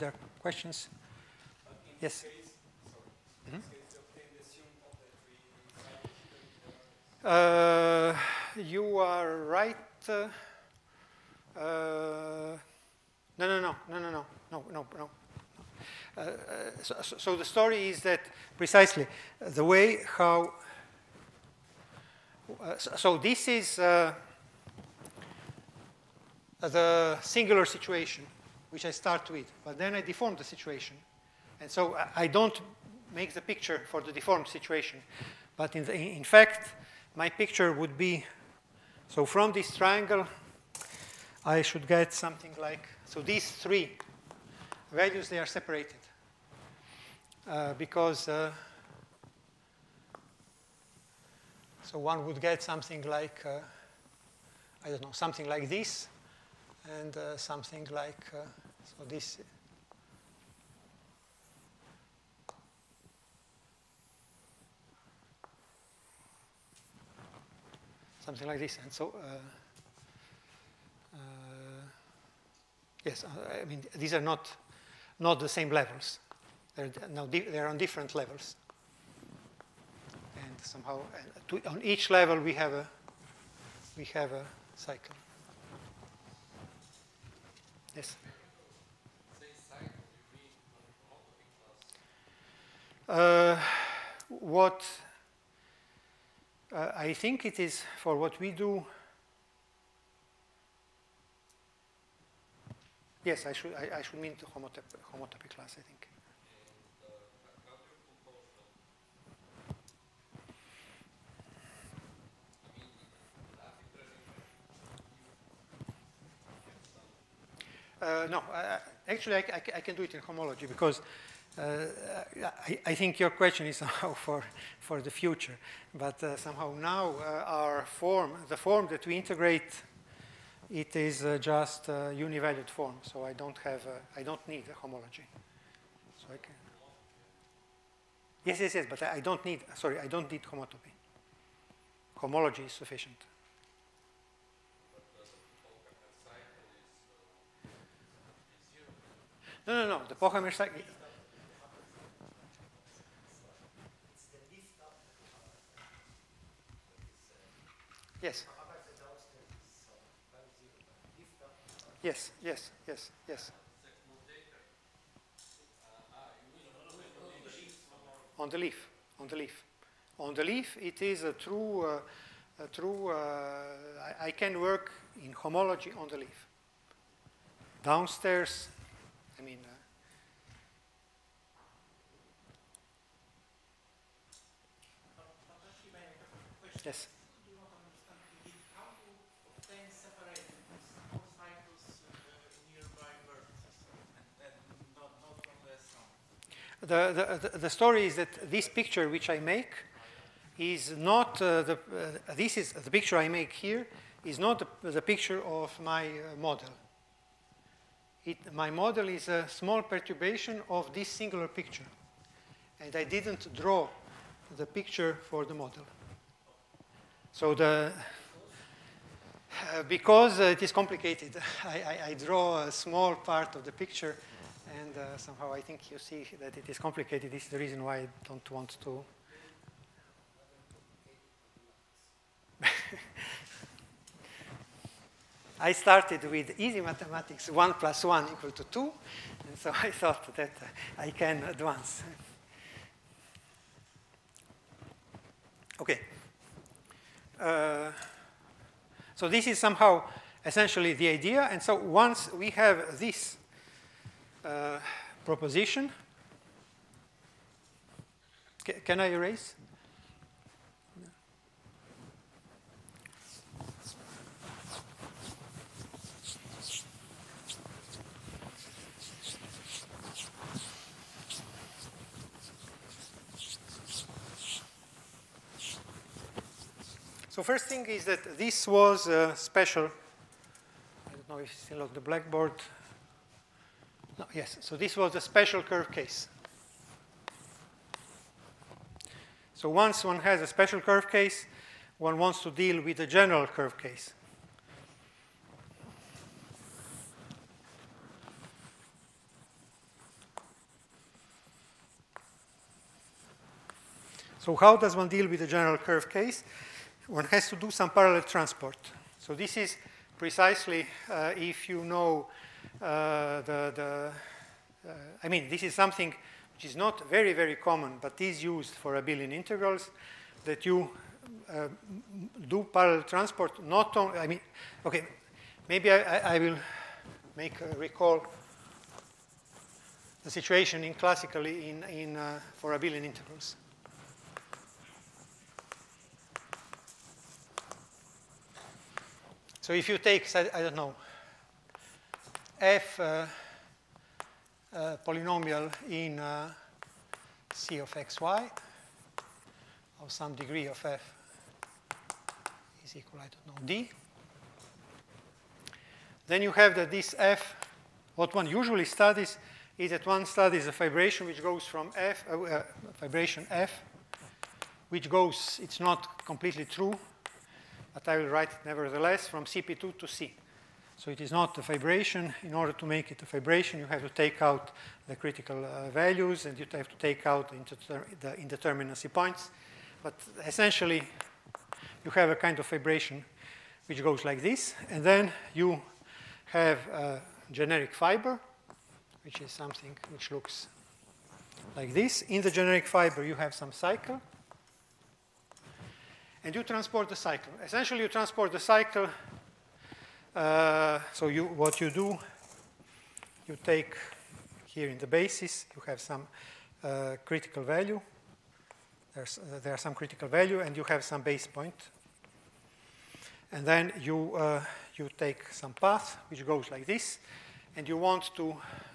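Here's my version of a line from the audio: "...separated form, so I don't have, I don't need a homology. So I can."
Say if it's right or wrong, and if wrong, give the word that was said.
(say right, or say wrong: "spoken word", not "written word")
wrong: "univalued", not "separated".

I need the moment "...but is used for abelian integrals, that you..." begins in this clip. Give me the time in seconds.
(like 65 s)
317 s.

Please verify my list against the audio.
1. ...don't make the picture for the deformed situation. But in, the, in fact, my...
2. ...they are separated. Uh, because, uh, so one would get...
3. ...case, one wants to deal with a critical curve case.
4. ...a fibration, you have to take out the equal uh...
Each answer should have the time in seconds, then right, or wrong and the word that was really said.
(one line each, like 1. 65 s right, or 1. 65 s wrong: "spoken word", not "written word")
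1. 32 s right
2. 45 s right
3. 291 s wrong: "general", not "critical"
4. 373 s wrong: "critical", not "equal".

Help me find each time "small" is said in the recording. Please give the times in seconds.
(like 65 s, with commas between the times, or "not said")
209 s, 222 s.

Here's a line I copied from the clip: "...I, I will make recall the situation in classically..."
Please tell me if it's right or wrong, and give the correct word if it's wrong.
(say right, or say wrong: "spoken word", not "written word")
right.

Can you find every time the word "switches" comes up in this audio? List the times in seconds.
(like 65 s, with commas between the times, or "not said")
not said.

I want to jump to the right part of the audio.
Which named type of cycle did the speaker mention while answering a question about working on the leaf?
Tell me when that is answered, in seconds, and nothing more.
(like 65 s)
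150 s.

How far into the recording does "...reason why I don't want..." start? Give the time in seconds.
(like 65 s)
227 s.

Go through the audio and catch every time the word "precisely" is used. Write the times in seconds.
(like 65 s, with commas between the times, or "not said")
18 s, 310 s.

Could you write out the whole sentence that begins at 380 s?
But essentially, you have a kind of fibration which goes like this.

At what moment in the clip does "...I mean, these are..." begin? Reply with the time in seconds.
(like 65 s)
73 s.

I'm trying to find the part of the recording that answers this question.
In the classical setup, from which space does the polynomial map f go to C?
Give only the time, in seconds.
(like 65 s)
369 s.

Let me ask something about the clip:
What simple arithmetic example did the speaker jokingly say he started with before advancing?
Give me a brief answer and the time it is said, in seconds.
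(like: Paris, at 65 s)
1 plus 1 equal to 2, at 237 s.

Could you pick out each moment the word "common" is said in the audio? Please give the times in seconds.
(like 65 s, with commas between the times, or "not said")
317 s.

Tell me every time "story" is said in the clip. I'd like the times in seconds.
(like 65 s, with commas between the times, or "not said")
17 s, 197 s.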